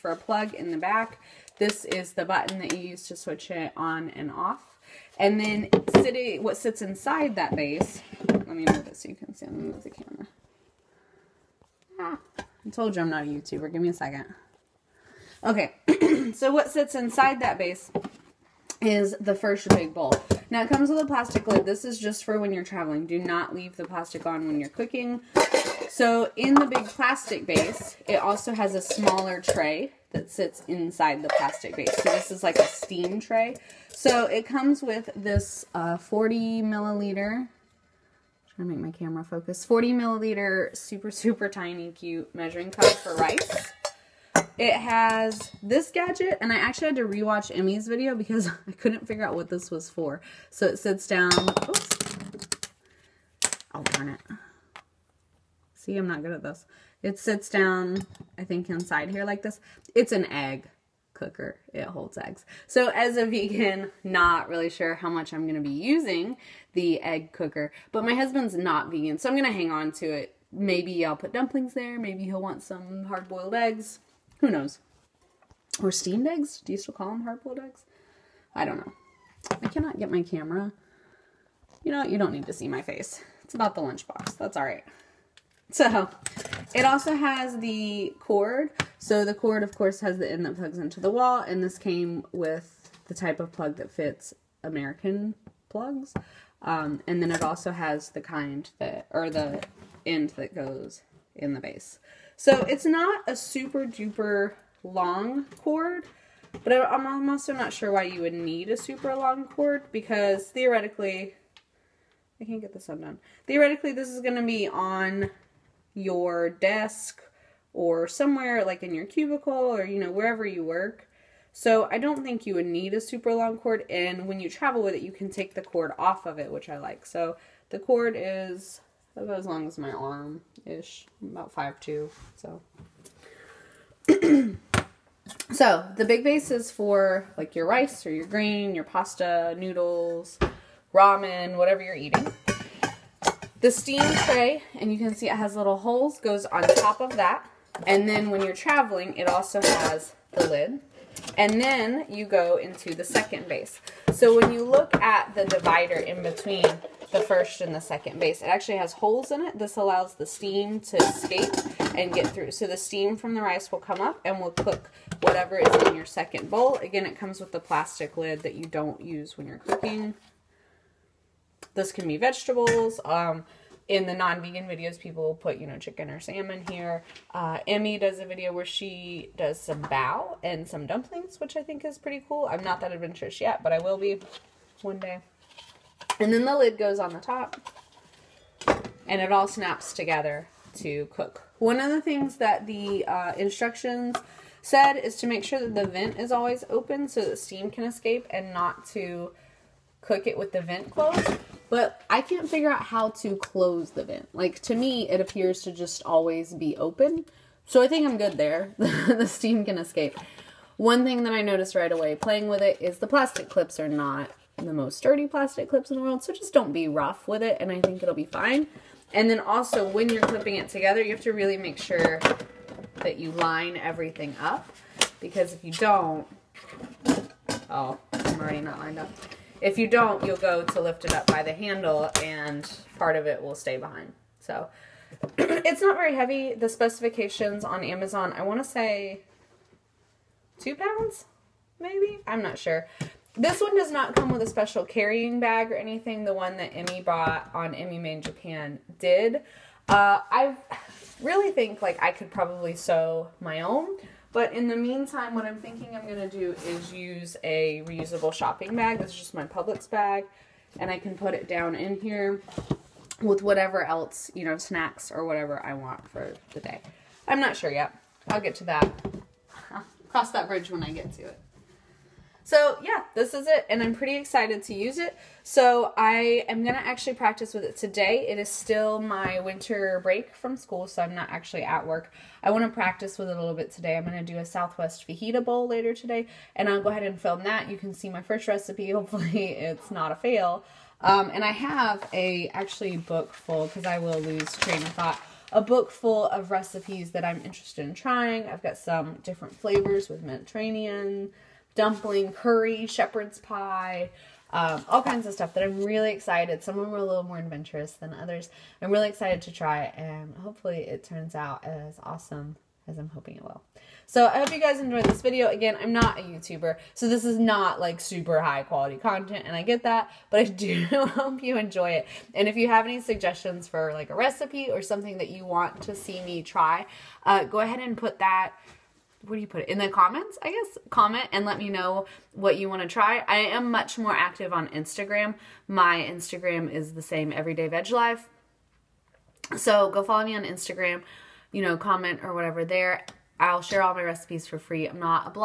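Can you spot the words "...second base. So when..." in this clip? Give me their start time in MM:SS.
02:33.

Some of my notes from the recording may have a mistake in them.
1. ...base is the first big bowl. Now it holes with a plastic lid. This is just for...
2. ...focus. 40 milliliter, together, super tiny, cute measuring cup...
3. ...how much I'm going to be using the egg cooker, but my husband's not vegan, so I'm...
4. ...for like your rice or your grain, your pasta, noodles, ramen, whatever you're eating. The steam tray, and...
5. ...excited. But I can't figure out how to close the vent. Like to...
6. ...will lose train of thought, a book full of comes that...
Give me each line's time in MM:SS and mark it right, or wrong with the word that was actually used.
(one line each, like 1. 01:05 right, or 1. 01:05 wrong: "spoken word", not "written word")
1. 00:17 wrong: "comes", not "holes"
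2. 00:39 wrong: "super", not "together"
3. 01:04 right
4. 02:16 right
5. 03:20 wrong: "closed", not "excited"
6. 04:53 wrong: "recipes", not "comes".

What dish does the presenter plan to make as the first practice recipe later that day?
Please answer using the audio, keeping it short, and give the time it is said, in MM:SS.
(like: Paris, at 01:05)
Southwest fajita bowl, at 04:44.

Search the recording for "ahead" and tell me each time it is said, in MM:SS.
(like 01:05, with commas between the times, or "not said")
04:46, 05:27.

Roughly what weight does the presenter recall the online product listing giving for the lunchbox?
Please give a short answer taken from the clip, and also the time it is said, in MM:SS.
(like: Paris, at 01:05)
2 pounds, at 04:00.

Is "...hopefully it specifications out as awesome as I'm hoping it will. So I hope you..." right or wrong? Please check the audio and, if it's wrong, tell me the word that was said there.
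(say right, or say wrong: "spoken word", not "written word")
wrong: "turns", not "specifications".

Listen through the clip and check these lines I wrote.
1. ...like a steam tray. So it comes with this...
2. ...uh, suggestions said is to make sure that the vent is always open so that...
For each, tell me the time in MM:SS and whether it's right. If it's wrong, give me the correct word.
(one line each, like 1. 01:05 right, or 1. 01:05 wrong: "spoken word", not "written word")
1. 00:32 right
2. 03:13 wrong: "instructions", not "suggestions".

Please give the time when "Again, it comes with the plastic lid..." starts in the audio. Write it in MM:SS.
02:46.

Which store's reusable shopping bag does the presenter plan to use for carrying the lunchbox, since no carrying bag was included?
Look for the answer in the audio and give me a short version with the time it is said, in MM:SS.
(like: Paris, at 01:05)
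Publix, at 04:19.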